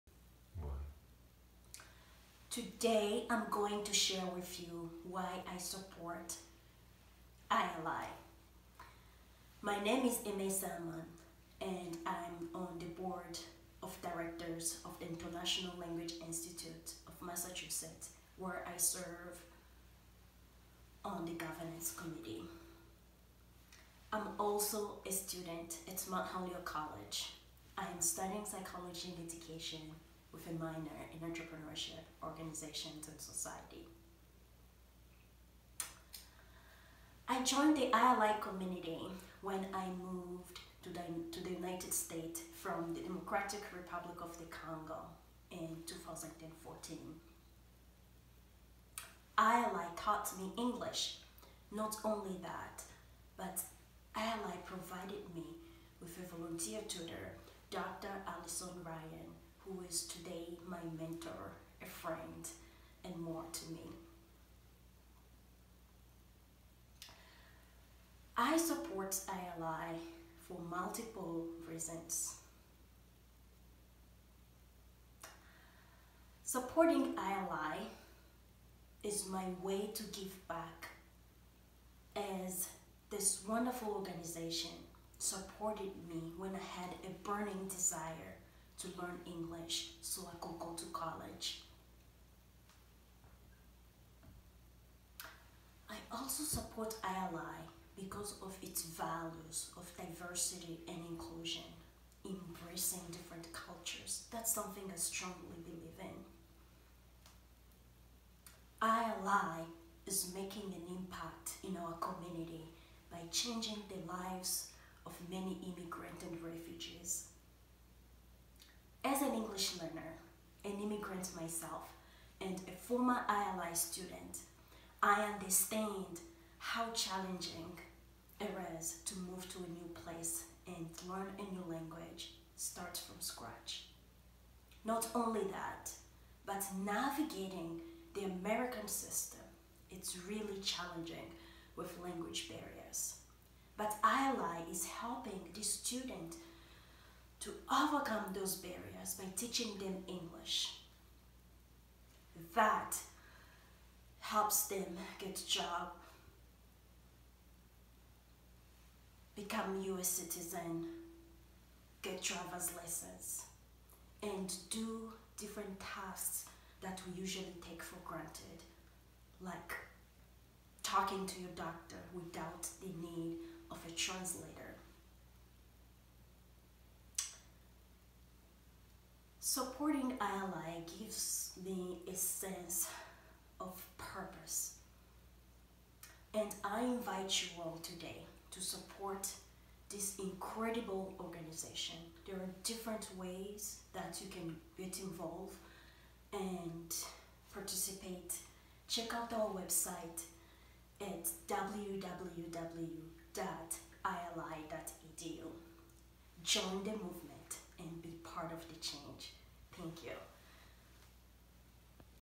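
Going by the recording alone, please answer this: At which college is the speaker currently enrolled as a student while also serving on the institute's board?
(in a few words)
Mount Holyoke College.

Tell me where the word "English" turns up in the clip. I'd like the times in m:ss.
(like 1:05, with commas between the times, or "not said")
0:50, 1:29, 1:59, 2:30.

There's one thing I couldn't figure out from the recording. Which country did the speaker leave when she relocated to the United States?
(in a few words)
Democratic Republic of the Congo.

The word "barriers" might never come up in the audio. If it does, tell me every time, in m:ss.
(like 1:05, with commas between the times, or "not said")
2:22, 2:28.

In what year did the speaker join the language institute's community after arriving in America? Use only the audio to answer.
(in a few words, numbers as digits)
2014.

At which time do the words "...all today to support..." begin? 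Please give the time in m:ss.
3:07.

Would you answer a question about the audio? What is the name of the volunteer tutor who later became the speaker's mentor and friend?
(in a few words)
Dr. Alison Ryan.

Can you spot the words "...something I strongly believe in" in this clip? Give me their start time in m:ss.
1:44.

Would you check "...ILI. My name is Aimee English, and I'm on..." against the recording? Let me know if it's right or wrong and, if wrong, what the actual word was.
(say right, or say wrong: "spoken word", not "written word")
wrong: "Salmon", not "English".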